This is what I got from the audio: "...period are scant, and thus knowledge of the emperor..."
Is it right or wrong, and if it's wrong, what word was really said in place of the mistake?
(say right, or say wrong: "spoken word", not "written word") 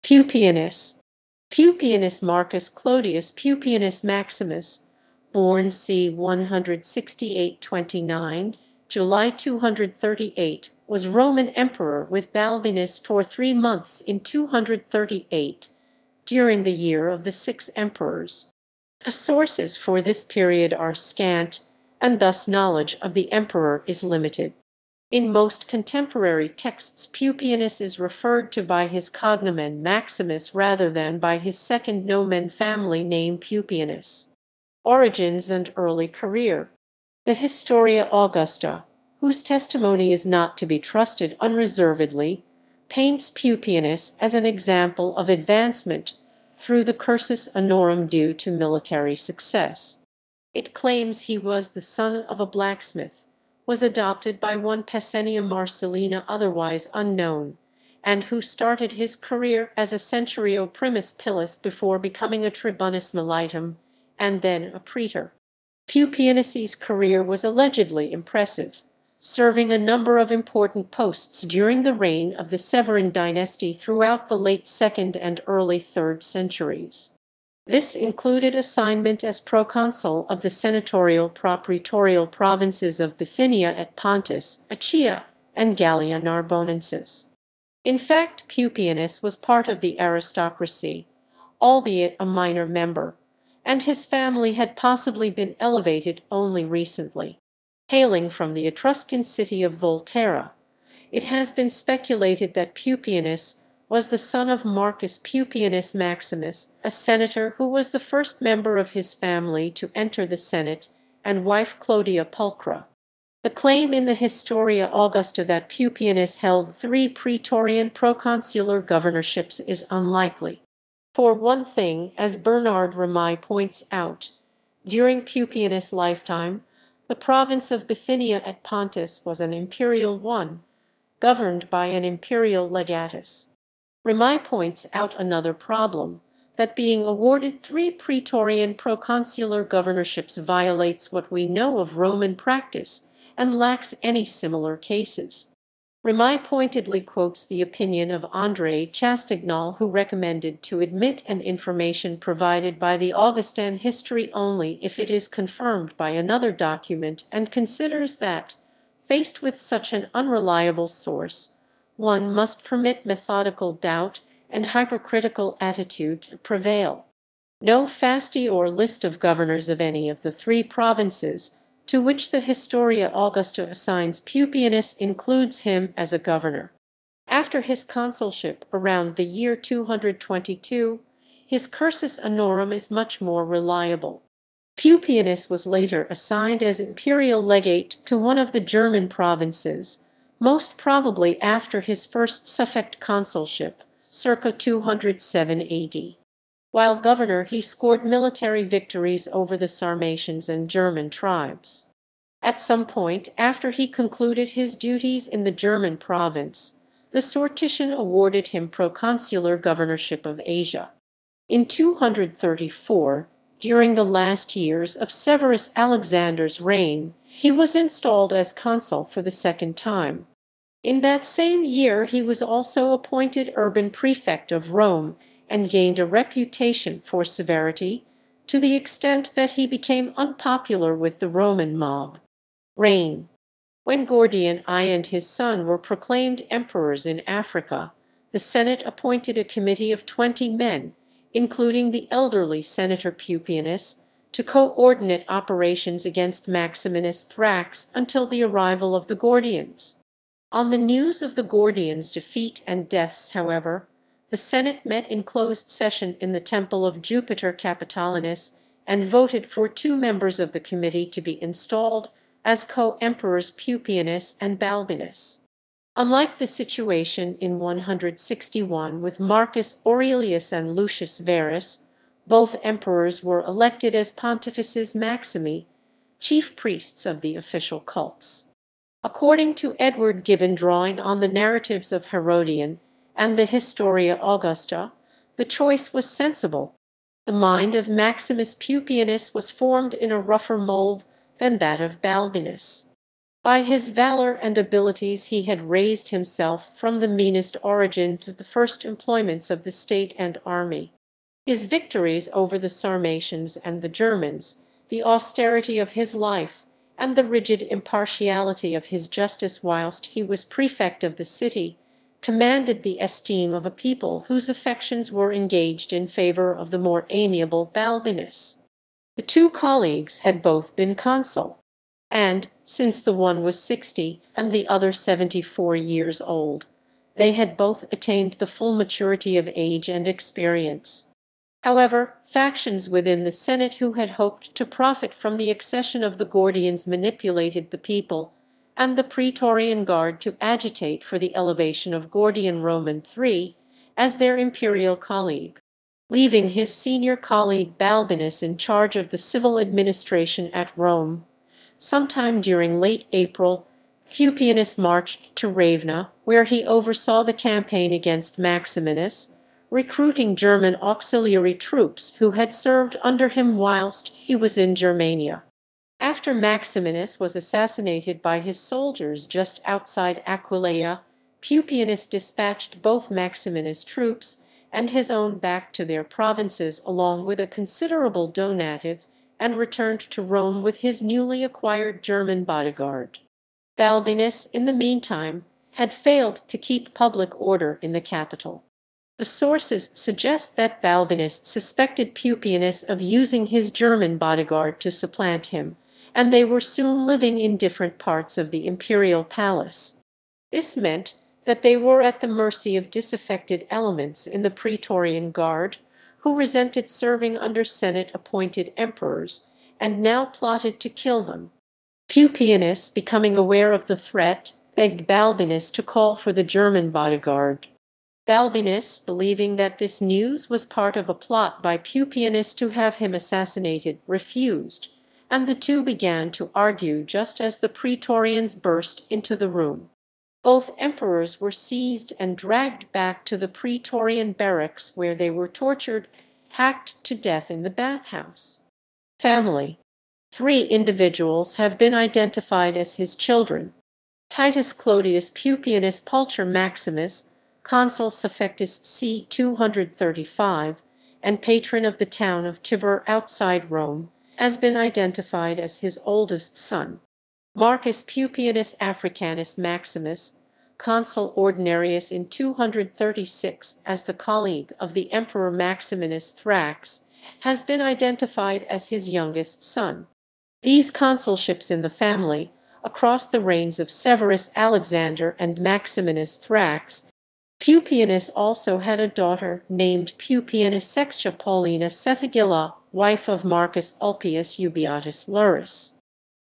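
right.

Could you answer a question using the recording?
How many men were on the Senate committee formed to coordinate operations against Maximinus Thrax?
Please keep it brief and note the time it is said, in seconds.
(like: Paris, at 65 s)
20, at 240 s.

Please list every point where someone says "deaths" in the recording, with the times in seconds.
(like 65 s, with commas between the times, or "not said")
252 s, 437 s.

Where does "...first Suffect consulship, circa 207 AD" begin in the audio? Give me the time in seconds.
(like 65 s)
192 s.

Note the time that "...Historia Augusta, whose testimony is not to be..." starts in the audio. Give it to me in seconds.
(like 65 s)
37 s.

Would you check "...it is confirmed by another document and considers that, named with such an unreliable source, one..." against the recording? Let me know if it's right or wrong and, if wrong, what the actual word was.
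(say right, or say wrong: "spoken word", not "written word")
wrong: "faced", not "named".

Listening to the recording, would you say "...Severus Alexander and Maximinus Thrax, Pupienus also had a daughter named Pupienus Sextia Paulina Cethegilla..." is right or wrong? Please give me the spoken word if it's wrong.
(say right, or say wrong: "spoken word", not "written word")
right.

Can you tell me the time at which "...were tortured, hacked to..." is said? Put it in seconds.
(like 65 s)
435 s.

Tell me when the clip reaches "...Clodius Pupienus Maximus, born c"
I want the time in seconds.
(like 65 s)
2 s.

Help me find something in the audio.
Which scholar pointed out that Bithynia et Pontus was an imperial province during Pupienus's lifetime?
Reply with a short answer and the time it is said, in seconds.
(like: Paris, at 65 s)
Bernard Remy, at 122 s.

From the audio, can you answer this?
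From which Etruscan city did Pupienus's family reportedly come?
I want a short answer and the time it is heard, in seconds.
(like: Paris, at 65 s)
Volterra, at 99 s.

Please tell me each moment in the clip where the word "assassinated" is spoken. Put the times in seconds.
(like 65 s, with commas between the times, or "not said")
367 s, 423 s.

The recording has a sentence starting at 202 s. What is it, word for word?
At some point after he concluded his duties in the German province, the Sortition awarded him proconsular governorship of Asia.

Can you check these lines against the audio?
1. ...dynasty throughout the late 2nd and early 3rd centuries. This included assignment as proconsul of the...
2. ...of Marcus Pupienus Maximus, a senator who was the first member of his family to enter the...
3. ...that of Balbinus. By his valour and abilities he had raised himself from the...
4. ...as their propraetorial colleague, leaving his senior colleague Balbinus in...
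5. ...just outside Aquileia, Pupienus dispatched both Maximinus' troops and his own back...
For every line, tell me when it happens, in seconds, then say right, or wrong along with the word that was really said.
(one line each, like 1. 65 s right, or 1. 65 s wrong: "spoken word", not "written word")
1. 73 s right
2. 104 s right
3. 291 s right
4. 343 s wrong: "imperial", not "propraetorial"
5. 369 s right.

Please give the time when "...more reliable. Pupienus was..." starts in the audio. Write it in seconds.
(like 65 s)
183 s.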